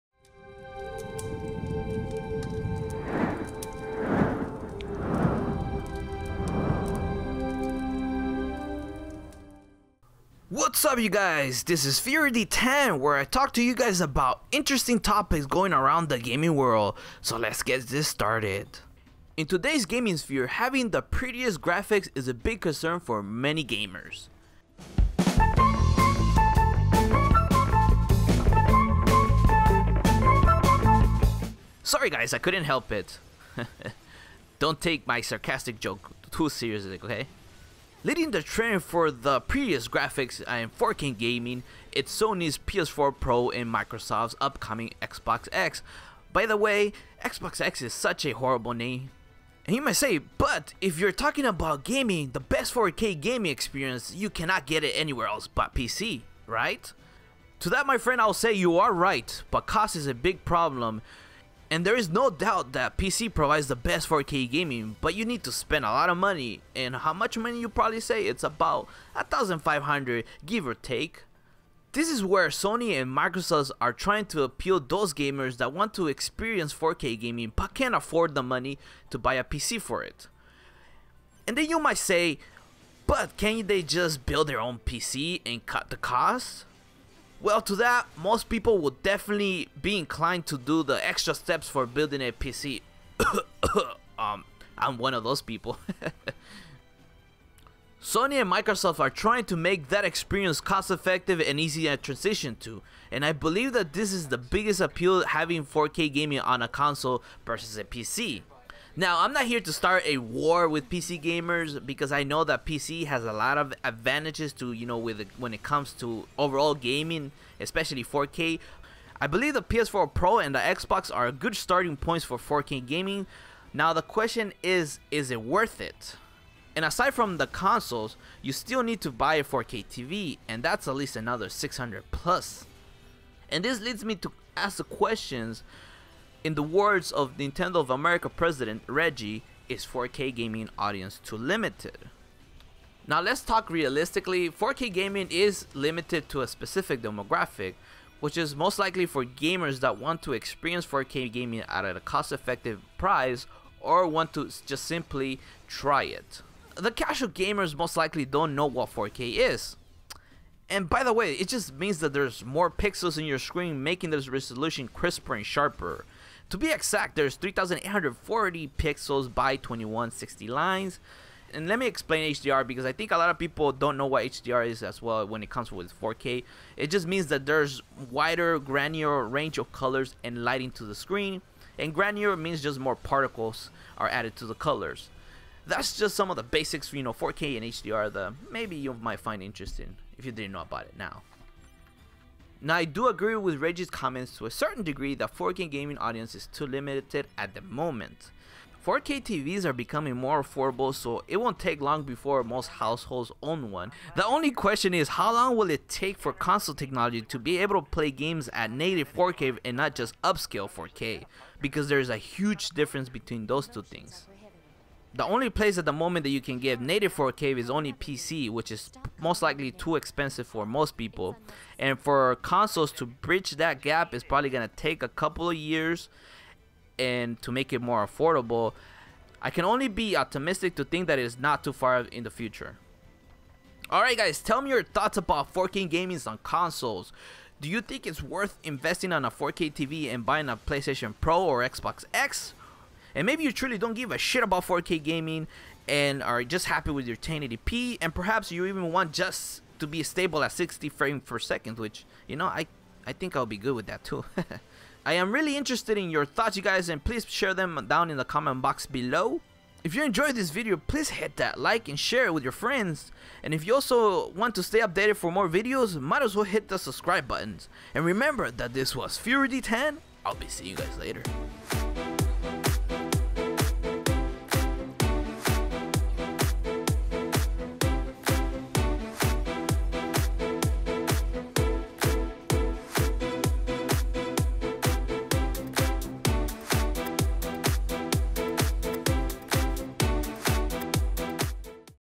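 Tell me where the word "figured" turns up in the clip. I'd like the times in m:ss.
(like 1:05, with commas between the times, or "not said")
not said.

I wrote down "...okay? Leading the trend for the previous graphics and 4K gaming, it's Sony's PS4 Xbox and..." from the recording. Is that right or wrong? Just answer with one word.
wrong.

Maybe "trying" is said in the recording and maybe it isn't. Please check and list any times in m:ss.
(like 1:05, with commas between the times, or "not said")
1:13, 1:39.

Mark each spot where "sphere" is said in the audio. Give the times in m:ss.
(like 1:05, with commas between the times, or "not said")
0:20.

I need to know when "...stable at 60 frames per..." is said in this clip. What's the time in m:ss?
4:10.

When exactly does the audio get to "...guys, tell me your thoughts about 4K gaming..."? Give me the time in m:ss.
3:54.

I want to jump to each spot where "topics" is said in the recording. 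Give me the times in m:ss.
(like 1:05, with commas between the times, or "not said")
0:14.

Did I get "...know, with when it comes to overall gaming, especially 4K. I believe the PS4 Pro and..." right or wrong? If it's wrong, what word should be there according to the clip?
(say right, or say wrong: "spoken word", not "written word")
right.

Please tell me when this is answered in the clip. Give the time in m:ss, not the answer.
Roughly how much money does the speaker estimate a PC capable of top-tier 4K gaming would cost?
1:09.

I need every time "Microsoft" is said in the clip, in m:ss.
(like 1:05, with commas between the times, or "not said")
0:43, 1:13, 1:38.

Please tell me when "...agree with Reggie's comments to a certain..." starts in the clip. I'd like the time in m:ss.
3:13.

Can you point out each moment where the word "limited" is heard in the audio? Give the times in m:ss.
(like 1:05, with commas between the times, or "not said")
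2:21, 2:25, 3:16.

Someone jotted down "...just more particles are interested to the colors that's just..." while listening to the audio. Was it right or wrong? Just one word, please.
wrong.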